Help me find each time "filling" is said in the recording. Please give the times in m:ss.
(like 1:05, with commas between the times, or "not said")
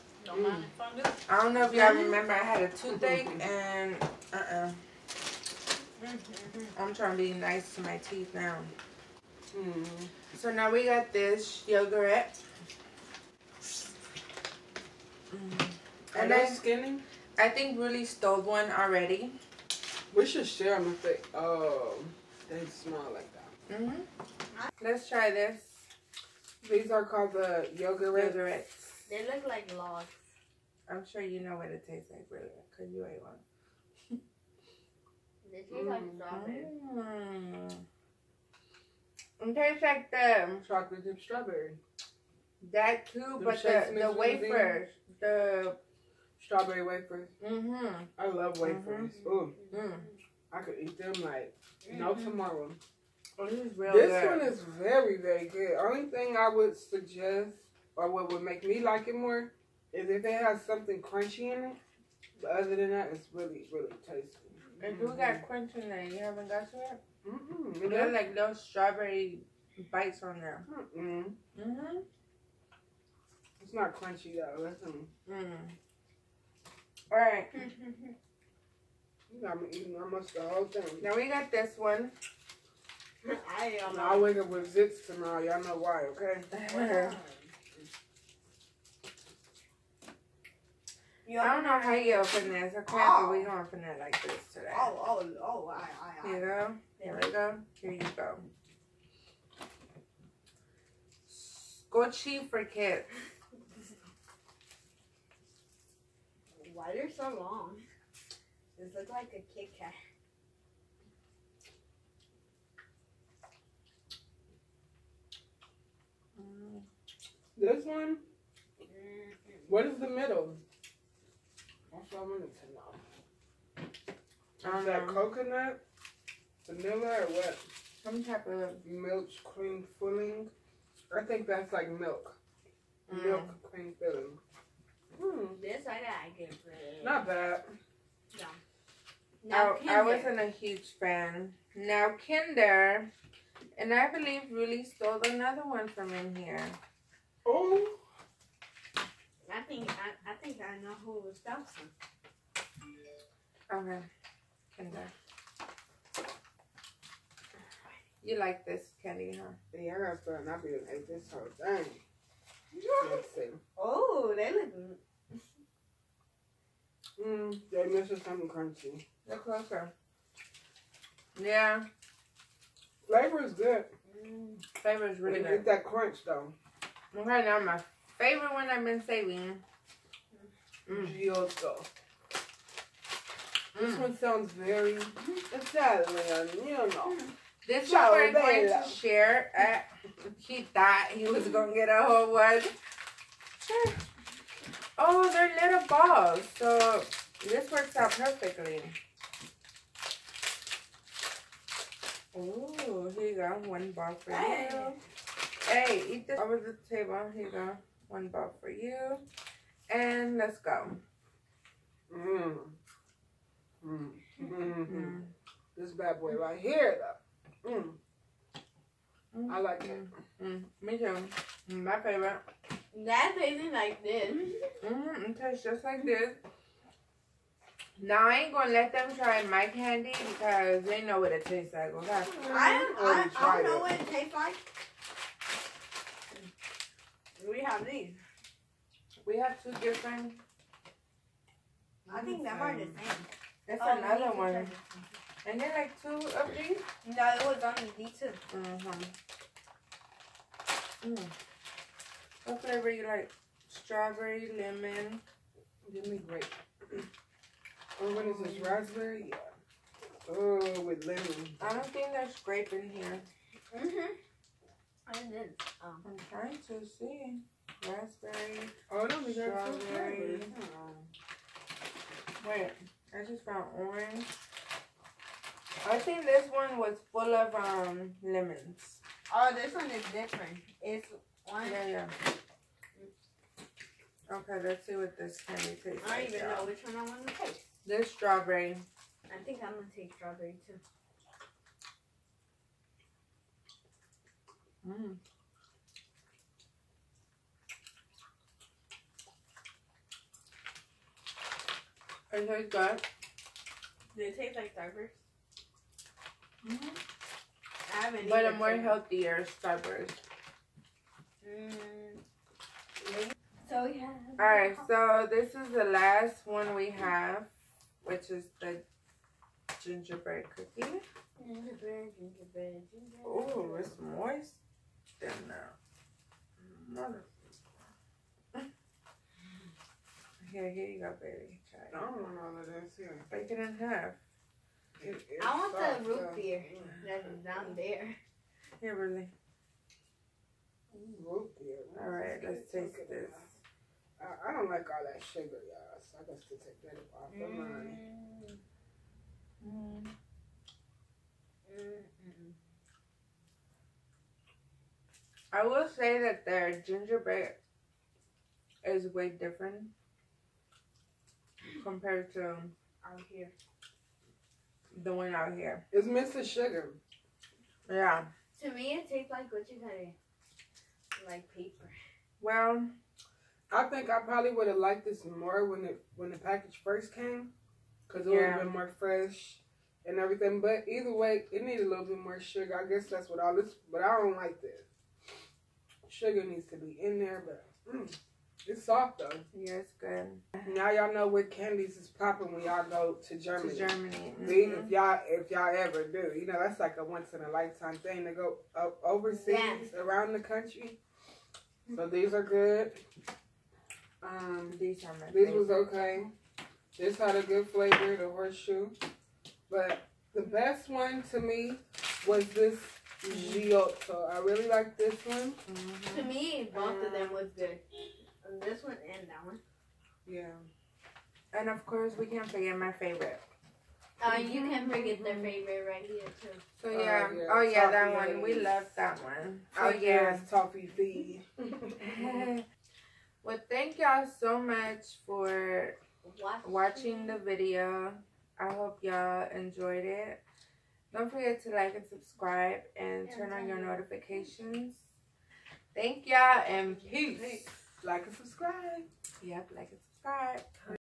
2:09, 2:13.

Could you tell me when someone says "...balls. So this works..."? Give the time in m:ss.
3:15.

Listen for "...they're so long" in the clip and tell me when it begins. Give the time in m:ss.
1:46.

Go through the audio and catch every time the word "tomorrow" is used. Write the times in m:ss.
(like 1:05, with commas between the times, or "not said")
0:52, 1:25.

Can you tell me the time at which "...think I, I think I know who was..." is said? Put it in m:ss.
2:29.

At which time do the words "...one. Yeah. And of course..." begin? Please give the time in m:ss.
6:59.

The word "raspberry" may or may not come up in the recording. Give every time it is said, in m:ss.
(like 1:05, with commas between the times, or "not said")
4:18, 4:27.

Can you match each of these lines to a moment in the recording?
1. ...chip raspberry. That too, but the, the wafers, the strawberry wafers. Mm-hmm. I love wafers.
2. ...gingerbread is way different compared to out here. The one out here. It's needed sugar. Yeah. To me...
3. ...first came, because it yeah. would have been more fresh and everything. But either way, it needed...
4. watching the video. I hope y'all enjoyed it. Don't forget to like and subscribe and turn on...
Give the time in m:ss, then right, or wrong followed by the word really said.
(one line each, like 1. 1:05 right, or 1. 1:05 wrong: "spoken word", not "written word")
1. 0:41 wrong: "strawberry", not "raspberry"
2. 5:56 wrong: "mixed", not "needed"
3. 6:16 right
4. 7:16 right.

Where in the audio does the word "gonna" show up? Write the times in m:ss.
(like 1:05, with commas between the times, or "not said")
3:48, 4:49.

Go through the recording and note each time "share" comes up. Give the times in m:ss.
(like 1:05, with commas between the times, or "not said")
0:20, 3:08.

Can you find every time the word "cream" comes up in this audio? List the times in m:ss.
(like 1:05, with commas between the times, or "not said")
2:09, 2:13.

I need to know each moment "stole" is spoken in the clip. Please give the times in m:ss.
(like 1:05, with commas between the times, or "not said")
0:18, 2:24.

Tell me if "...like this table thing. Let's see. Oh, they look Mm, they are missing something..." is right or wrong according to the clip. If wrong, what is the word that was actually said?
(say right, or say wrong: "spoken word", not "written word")
wrong: "whole", not "table".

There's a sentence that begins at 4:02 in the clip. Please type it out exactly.
I think them are the same.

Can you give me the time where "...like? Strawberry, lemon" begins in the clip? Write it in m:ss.
4:13.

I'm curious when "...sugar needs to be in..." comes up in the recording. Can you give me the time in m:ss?
6:26.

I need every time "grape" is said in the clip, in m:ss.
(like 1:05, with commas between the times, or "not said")
4:16, 4:22.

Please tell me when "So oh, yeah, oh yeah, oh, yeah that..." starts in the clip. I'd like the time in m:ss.
7:06.